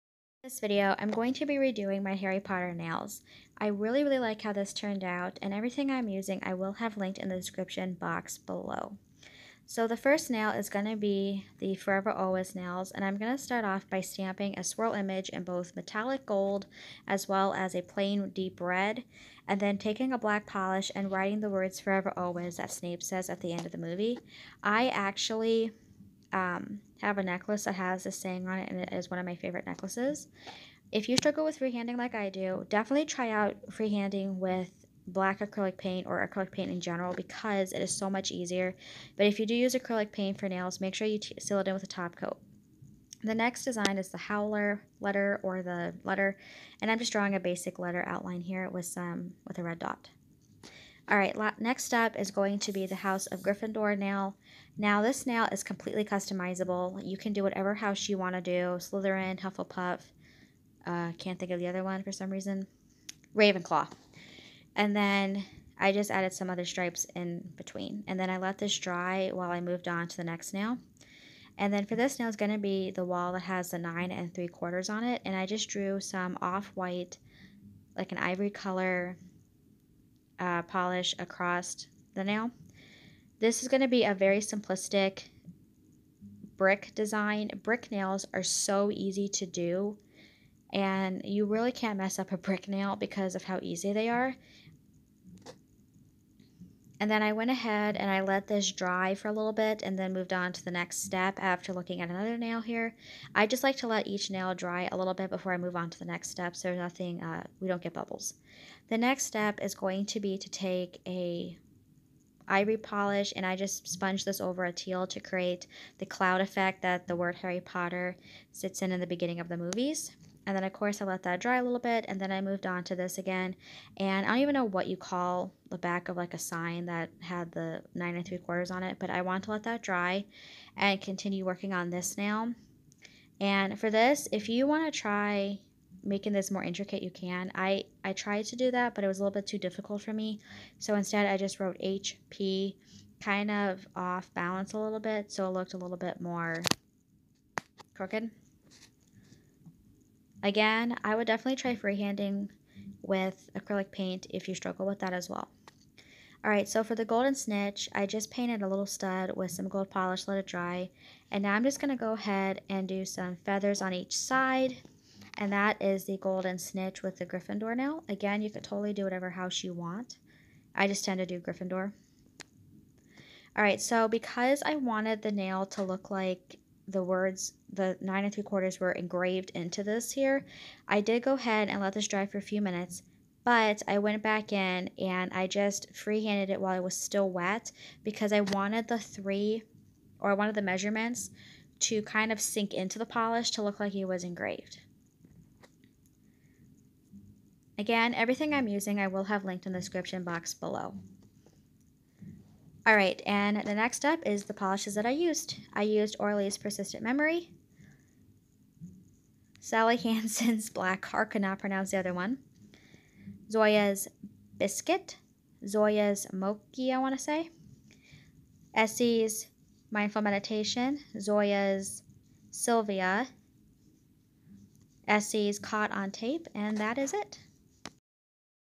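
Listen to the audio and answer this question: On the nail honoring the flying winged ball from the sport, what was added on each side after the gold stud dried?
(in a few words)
feathers.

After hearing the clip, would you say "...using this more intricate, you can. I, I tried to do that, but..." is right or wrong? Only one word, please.
wrong.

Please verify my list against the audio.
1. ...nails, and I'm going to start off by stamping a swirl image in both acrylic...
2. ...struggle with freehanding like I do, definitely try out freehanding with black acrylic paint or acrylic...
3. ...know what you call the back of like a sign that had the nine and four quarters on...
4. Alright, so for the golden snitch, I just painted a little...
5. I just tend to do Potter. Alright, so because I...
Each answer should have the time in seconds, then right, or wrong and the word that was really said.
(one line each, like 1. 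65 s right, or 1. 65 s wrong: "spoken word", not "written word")
1. 12 s wrong: "metallic", not "acrylic"
2. 31 s right
3. 124 s wrong: "three", not "four"
4. 156 s right
5. 170 s wrong: "Gryffindor", not "Potter".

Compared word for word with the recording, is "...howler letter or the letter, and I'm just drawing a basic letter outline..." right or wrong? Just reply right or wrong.
right.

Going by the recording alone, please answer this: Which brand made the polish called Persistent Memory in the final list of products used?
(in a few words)
Orly.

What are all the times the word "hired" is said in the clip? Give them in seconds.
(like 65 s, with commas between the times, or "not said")
not said.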